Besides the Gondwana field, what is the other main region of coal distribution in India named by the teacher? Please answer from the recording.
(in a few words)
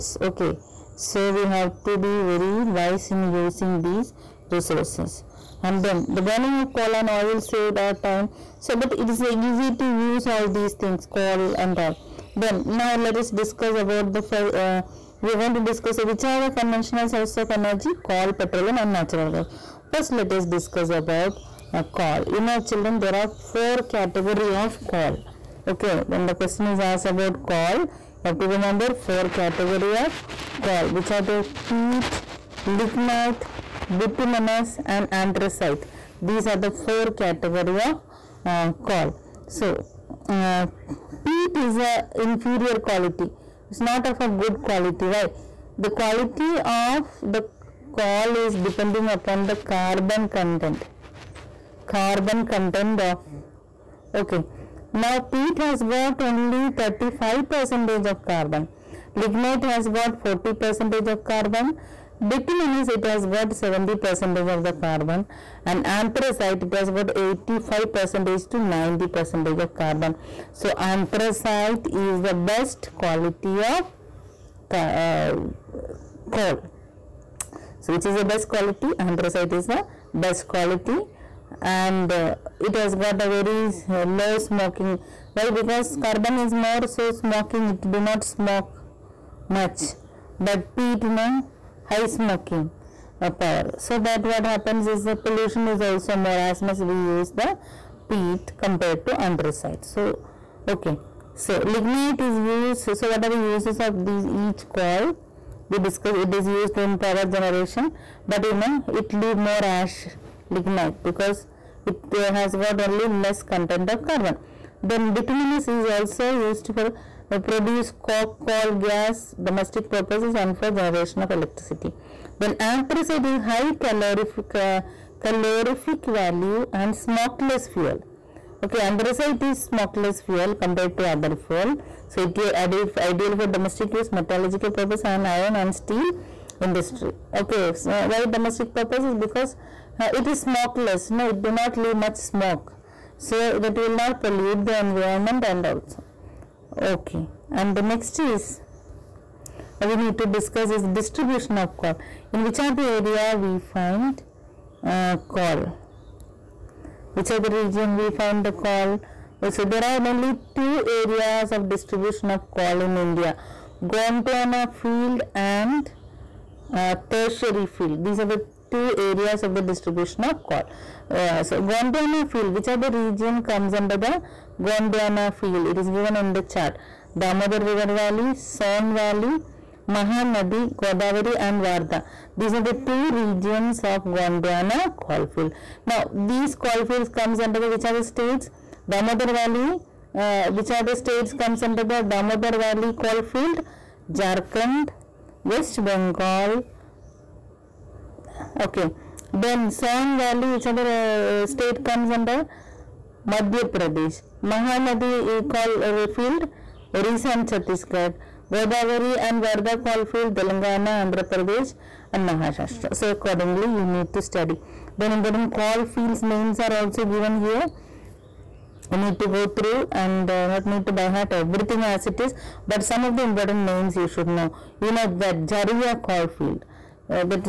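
Tertiary field.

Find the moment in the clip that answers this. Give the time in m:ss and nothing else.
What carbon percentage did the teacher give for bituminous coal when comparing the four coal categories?
1:03.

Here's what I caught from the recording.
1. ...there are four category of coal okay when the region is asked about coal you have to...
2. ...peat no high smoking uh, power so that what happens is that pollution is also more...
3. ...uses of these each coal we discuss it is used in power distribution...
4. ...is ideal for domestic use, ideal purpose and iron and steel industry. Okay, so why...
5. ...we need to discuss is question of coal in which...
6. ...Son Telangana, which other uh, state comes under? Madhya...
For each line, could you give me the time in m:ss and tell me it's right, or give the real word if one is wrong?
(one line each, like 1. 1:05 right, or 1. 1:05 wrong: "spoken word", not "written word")
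1. 0:23 wrong: "question", not "region"
2. 1:30 right
3. 1:43 wrong: "generation", not "distribution"
4. 2:12 wrong: "metallurgical", not "ideal"
5. 2:29 wrong: "distribution", not "question"
6. 3:19 wrong: "Valley", not "Telangana".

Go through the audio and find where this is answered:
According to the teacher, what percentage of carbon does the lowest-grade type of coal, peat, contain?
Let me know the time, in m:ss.
0:56.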